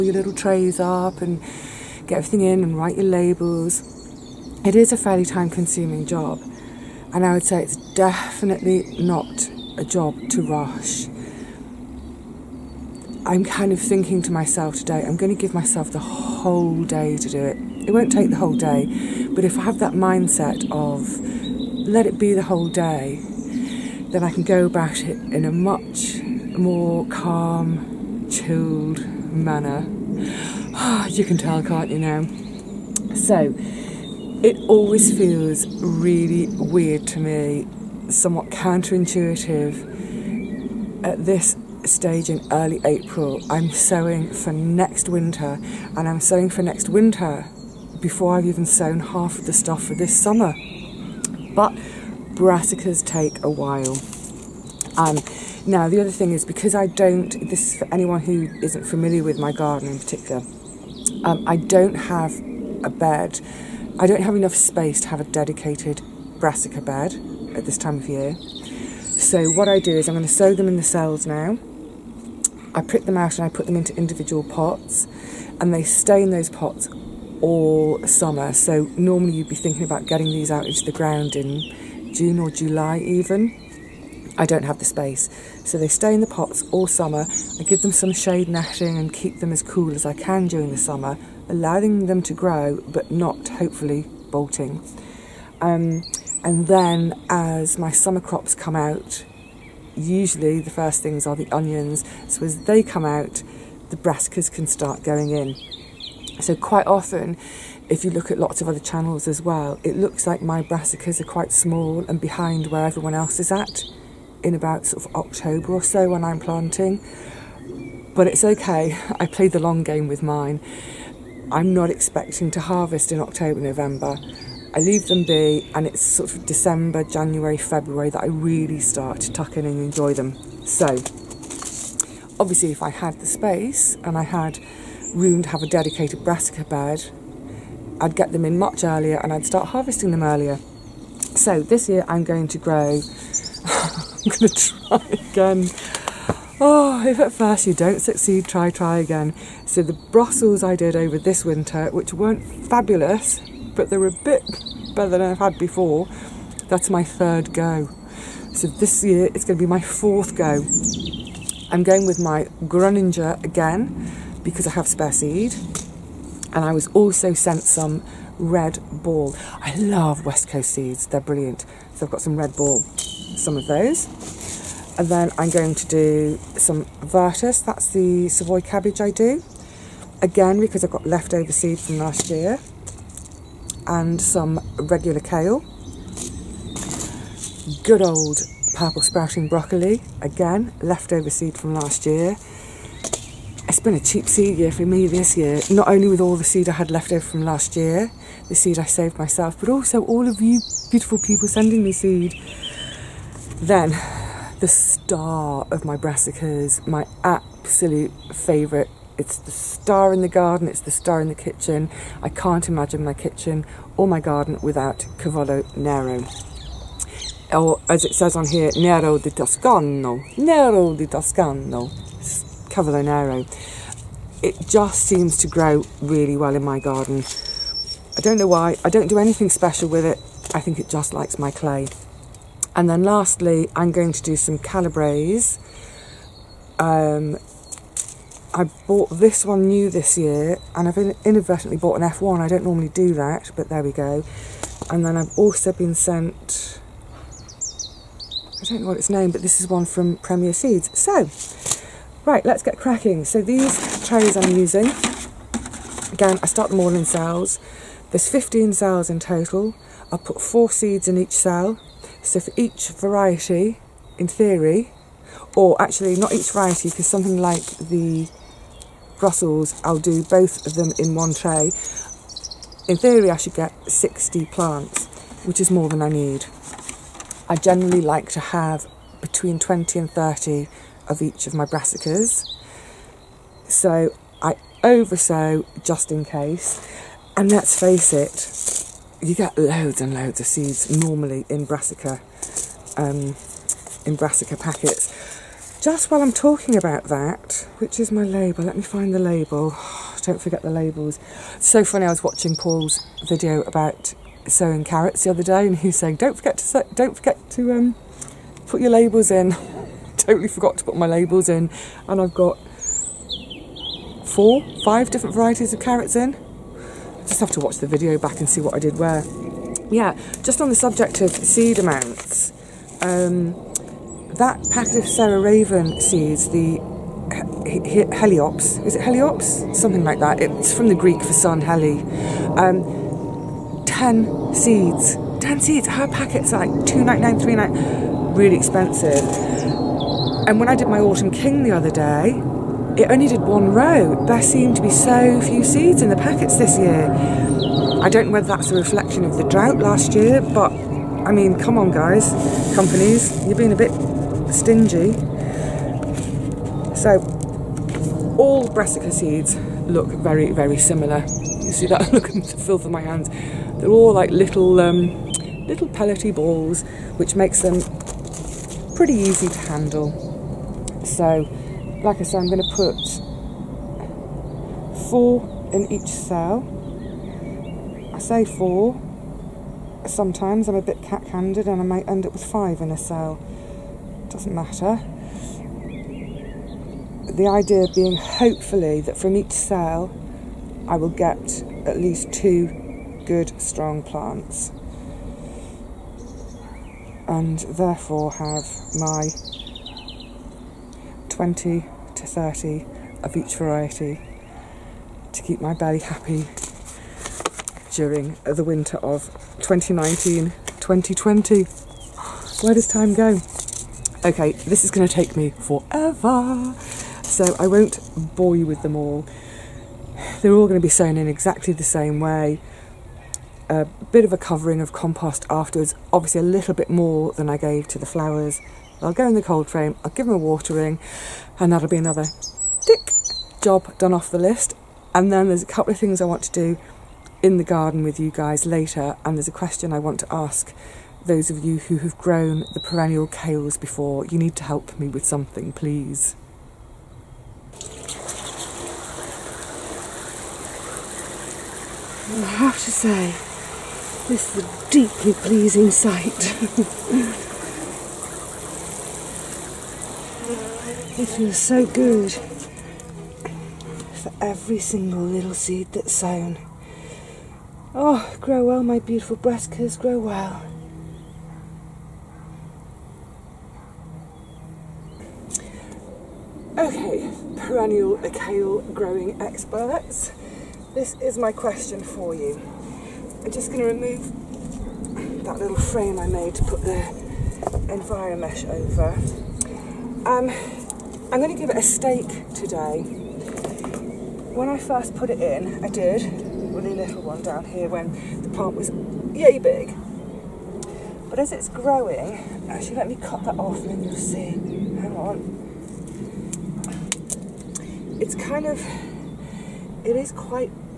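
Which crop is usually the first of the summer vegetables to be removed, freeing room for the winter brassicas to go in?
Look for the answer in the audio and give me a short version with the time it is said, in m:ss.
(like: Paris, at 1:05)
onions, at 1:41.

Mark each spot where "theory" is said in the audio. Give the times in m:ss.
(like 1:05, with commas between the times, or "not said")
4:24, 4:32.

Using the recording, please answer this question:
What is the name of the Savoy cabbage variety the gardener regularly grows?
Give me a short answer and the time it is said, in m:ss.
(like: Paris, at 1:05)
vertus, at 2:57.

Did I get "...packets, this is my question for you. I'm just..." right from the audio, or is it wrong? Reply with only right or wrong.
wrong.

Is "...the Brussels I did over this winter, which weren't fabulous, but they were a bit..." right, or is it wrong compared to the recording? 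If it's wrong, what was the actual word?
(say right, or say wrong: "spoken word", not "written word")
right.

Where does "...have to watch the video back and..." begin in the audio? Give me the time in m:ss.
5:17.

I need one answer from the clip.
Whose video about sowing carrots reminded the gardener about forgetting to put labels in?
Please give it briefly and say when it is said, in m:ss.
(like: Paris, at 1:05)
Paul, at 5:02.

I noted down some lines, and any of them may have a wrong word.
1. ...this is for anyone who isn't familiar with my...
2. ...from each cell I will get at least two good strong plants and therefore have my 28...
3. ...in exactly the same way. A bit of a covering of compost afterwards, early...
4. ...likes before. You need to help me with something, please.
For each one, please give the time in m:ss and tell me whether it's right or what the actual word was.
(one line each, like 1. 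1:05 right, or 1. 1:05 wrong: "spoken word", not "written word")
1. 0:57 right
2. 6:29 wrong: "20", not "28"
3. 7:01 wrong: "obviously", not "early"
4. 7:23 wrong: "kales", not "likes".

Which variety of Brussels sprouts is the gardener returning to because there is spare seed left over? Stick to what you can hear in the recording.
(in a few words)
Groninger.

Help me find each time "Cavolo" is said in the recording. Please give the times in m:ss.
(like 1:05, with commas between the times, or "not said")
3:35, 3:42.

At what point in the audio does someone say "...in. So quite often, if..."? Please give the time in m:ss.
1:45.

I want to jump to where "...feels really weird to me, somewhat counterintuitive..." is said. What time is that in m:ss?
0:35.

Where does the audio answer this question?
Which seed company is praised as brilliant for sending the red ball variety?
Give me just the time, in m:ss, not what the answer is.
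2:50.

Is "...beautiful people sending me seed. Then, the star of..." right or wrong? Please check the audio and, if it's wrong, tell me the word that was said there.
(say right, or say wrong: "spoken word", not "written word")
right.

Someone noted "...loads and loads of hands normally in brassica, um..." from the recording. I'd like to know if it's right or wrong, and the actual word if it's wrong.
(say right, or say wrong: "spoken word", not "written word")
wrong: "seeds", not "hands".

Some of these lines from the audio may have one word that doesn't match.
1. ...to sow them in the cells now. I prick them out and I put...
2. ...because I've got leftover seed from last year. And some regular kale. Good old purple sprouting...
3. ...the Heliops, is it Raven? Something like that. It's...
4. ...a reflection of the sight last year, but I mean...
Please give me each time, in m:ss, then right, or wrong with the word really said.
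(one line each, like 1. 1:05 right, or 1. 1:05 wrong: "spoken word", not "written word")
1. 1:10 right
2. 3:00 right
3. 5:26 wrong: "Heliops", not "Raven"
4. 5:48 wrong: "drought", not "sight".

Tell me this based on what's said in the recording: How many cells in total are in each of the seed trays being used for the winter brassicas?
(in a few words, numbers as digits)
15.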